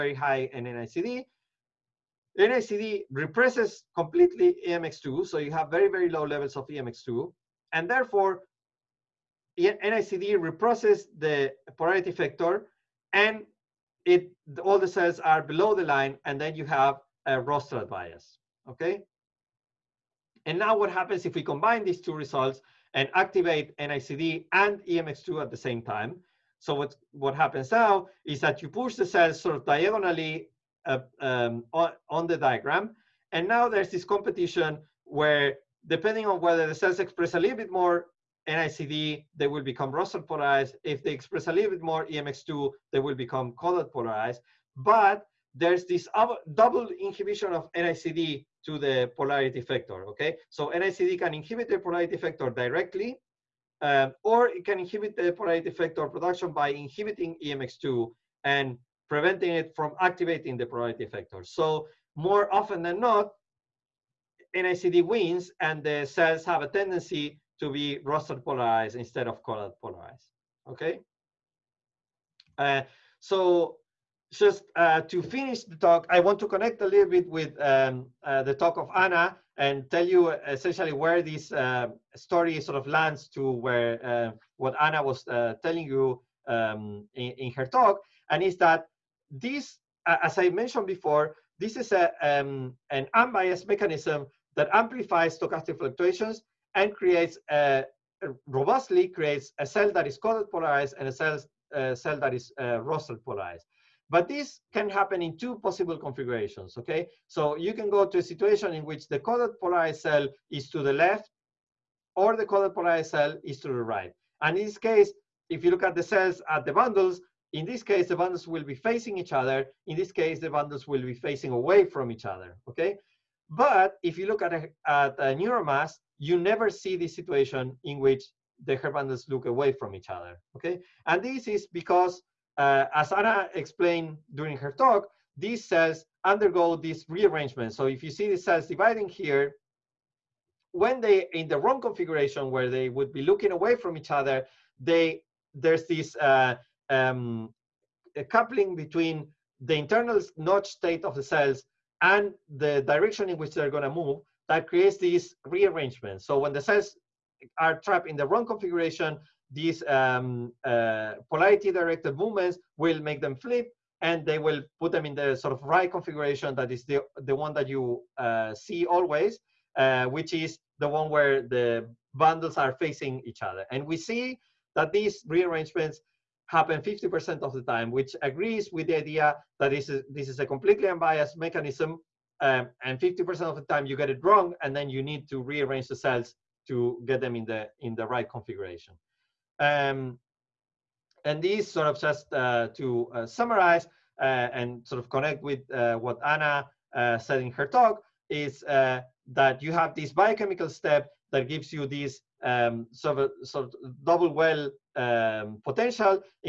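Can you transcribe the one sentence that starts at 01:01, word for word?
So more often than not, NICD wins and the cells have a tendency to be rostral polarized instead of caudal polarized, okay?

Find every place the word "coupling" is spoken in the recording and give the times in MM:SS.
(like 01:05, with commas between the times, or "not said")
02:28.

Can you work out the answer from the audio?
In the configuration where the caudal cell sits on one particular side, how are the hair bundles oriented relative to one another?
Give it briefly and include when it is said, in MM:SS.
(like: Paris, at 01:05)
facing away from each other, at 02:01.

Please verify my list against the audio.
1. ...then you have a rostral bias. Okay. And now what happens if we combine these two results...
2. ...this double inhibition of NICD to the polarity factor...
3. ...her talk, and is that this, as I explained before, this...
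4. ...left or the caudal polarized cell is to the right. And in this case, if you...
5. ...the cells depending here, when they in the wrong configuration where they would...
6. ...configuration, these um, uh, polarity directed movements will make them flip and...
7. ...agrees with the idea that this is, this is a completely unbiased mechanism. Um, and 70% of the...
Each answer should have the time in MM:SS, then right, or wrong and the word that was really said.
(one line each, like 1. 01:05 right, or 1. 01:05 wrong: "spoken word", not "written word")
1. 00:16 right
2. 00:45 right
3. 01:27 wrong: "mentioned", not "explained"
4. 01:50 right
5. 02:18 wrong: "dividing", not "depending"
6. 02:38 right
7. 02:58 wrong: "50", not "70".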